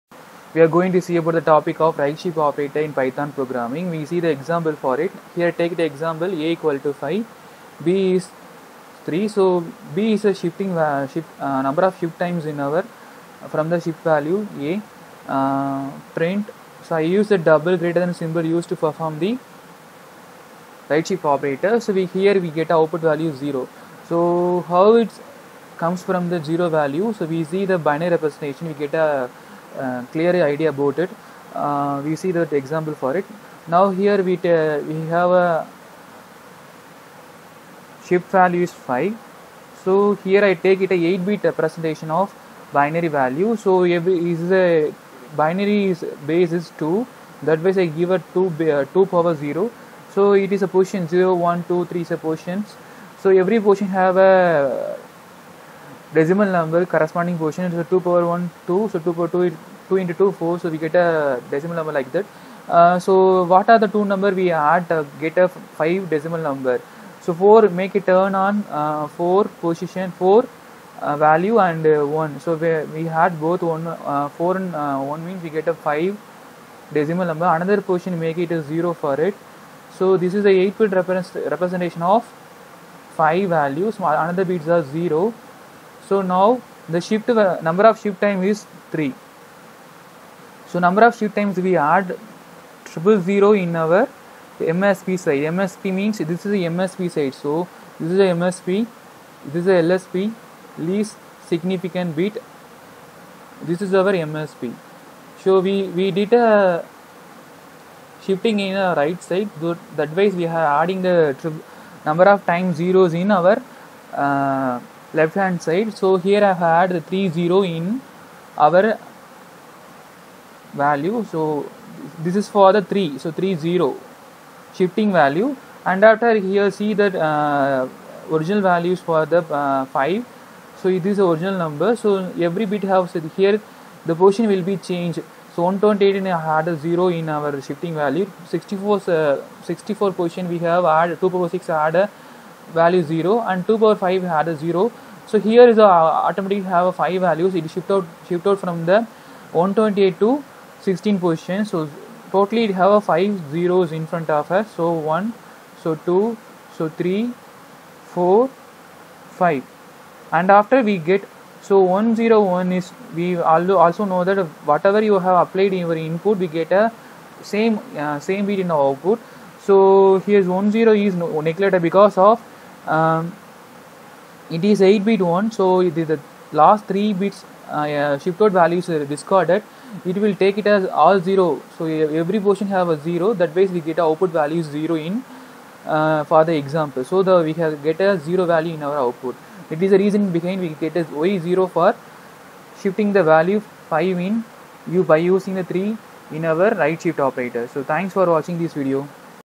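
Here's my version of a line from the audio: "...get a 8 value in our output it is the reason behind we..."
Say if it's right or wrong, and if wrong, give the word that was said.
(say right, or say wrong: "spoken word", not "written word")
wrong: "0", not "8".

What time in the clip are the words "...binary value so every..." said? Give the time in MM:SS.
00:42.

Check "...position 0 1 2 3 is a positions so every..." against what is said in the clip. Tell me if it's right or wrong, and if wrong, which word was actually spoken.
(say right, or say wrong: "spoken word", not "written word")
right.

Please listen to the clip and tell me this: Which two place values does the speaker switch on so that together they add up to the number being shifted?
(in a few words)
4 and 1.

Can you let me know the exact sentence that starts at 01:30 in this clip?
So number of shift times we add triple zero in our MSB side.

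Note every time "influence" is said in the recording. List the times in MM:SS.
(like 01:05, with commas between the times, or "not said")
not said.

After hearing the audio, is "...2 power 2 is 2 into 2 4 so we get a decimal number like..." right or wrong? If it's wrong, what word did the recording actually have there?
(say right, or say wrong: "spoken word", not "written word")
right.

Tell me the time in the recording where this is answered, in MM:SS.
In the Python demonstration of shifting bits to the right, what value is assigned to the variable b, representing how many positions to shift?
00:07.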